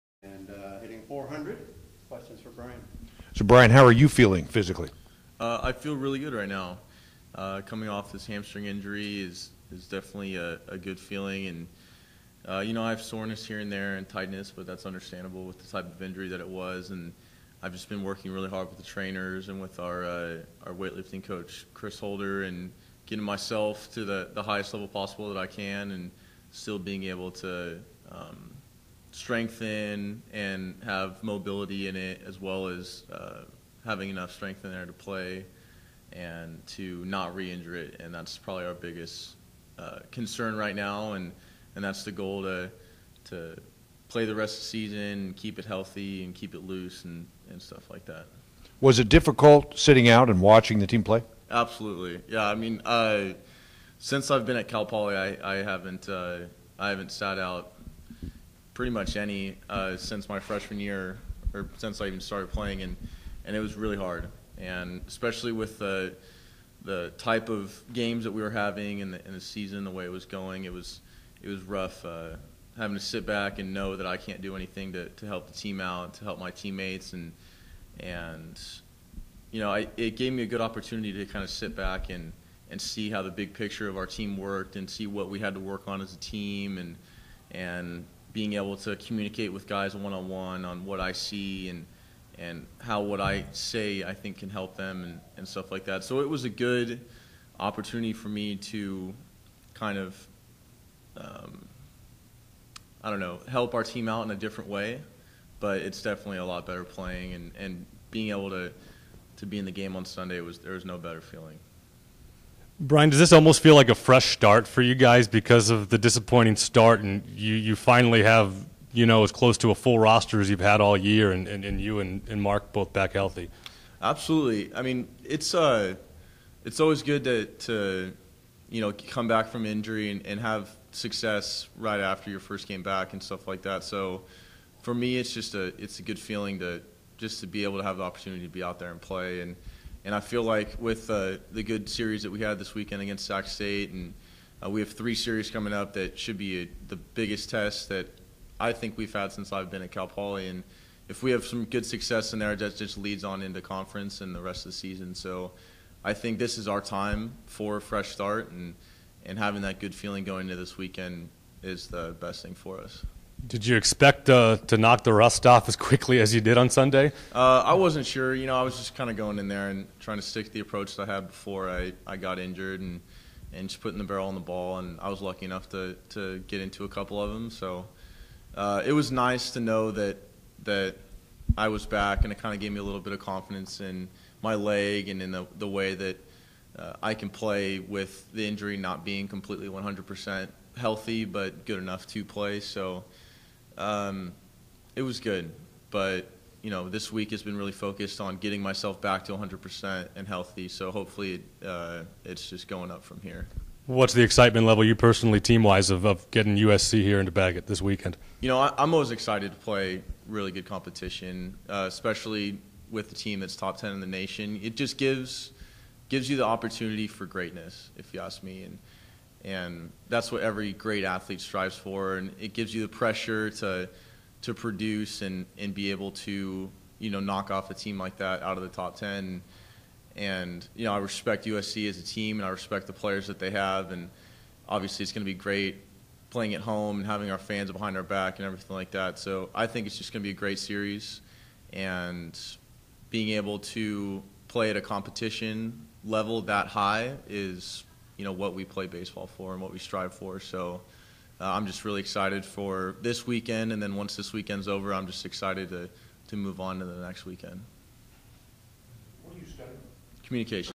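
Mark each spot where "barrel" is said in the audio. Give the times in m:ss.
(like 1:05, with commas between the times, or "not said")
2:54.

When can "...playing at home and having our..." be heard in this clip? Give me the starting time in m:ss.
3:56.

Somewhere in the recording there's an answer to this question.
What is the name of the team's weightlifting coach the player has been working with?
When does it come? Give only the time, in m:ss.
0:21.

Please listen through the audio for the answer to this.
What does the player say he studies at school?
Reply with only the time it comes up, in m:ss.
4:20.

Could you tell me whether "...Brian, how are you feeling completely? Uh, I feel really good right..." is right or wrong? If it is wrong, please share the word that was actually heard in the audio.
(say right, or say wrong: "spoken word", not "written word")
wrong: "physically", not "completely".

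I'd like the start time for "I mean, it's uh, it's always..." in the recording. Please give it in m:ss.
2:04.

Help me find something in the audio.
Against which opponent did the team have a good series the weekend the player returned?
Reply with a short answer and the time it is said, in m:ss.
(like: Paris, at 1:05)
Sac State, at 2:23.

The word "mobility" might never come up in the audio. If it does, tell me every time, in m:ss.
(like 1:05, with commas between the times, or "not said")
0:31.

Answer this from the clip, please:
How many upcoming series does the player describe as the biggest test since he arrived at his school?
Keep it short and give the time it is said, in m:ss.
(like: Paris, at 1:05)
3, at 2:24.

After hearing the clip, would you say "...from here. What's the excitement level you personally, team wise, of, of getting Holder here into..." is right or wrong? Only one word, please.
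wrong.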